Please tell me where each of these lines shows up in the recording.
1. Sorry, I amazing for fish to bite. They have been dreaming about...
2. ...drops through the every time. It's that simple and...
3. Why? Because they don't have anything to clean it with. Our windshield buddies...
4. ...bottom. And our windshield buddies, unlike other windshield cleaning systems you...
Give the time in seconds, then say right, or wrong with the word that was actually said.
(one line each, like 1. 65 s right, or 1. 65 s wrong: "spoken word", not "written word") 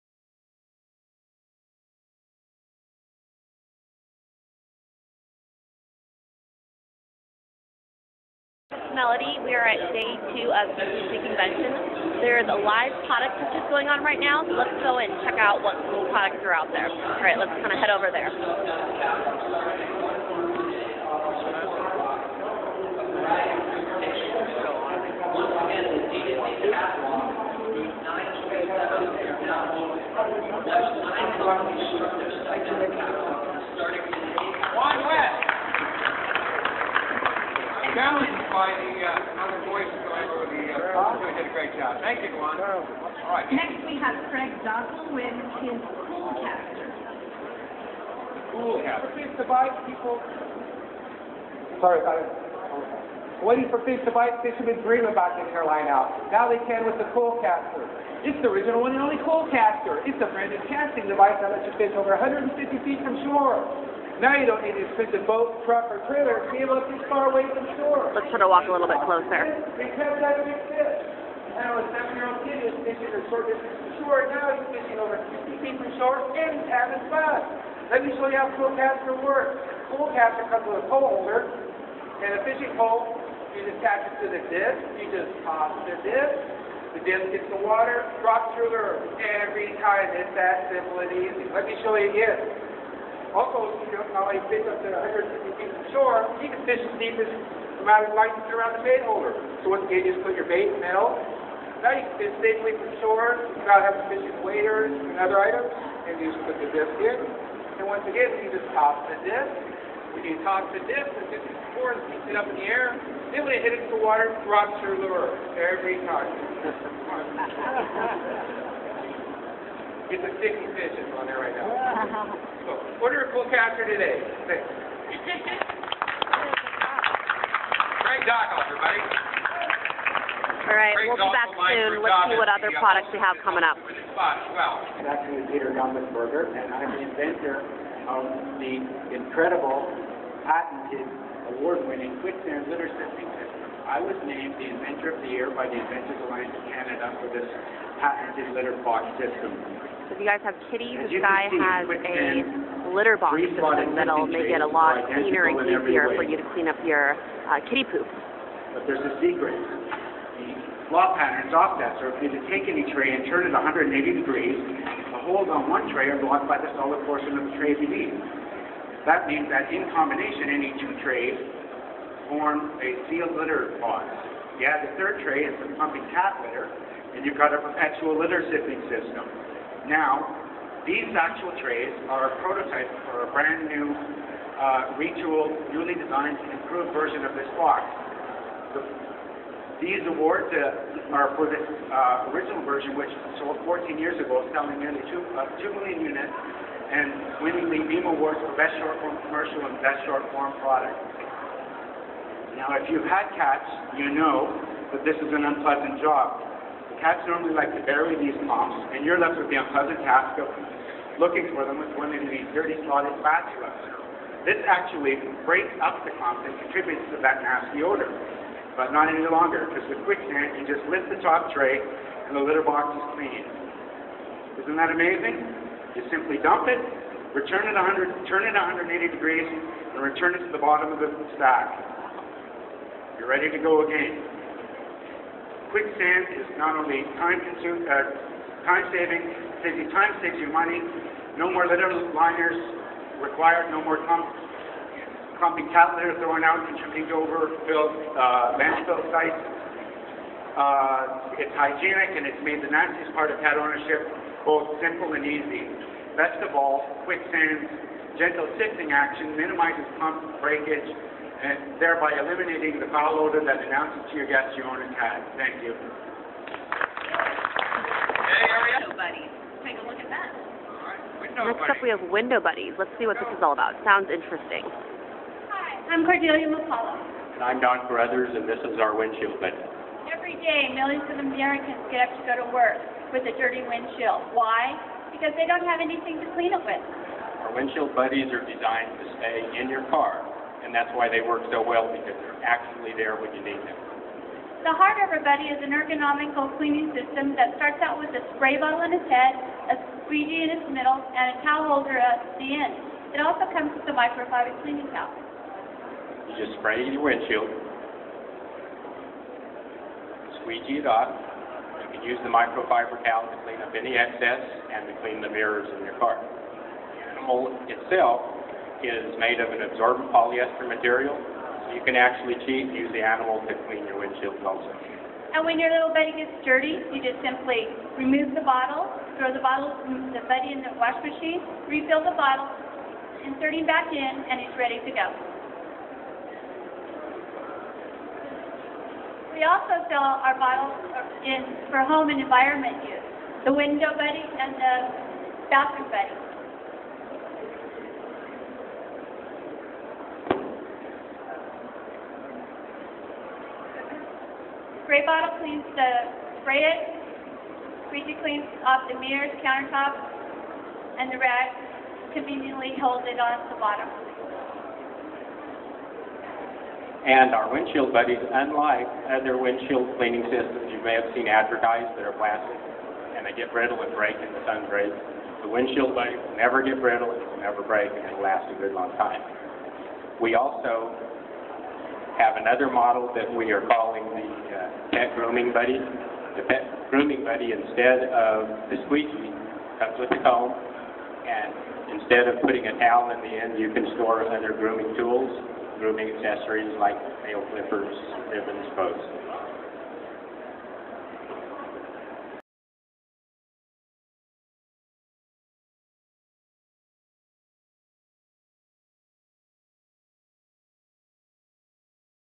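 1. 51 s wrong: "waiting", not "amazing"
2. 88 s right
3. 284 s right
4. 363 s right.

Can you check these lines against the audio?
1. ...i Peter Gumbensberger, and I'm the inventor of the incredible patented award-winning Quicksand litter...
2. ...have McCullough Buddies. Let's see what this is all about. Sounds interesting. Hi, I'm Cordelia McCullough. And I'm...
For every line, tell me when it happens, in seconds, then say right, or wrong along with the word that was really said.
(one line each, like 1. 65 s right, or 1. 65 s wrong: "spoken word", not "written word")
1. 135 s right
2. 271 s wrong: "Window", not "McCullough".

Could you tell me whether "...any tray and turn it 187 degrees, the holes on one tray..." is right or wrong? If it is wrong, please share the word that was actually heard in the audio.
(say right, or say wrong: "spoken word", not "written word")
wrong: "180", not "187".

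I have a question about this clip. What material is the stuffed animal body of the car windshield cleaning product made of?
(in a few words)
absorbent polyester.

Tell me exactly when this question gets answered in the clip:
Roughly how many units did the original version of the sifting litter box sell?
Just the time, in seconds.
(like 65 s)
195 s.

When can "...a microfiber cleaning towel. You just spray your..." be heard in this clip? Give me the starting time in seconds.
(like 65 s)
303 s.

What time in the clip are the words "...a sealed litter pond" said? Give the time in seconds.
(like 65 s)
172 s.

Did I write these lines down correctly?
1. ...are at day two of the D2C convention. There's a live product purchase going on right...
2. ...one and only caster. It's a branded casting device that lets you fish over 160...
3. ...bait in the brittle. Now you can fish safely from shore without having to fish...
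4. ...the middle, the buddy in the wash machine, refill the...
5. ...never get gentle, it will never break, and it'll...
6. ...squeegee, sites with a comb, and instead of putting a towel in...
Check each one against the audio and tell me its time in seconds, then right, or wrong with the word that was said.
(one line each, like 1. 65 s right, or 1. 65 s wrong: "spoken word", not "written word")
1. 9 s right
2. 58 s wrong: "150", not "160"
3. 100 s wrong: "middle", not "brittle"
4. 329 s wrong: "bottle", not "middle"
5. 376 s wrong: "brittle", not "gentle"
6. 388 s wrong: "comes", not "sites".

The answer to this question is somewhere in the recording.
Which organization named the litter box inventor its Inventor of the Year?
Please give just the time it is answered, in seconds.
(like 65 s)
145 s.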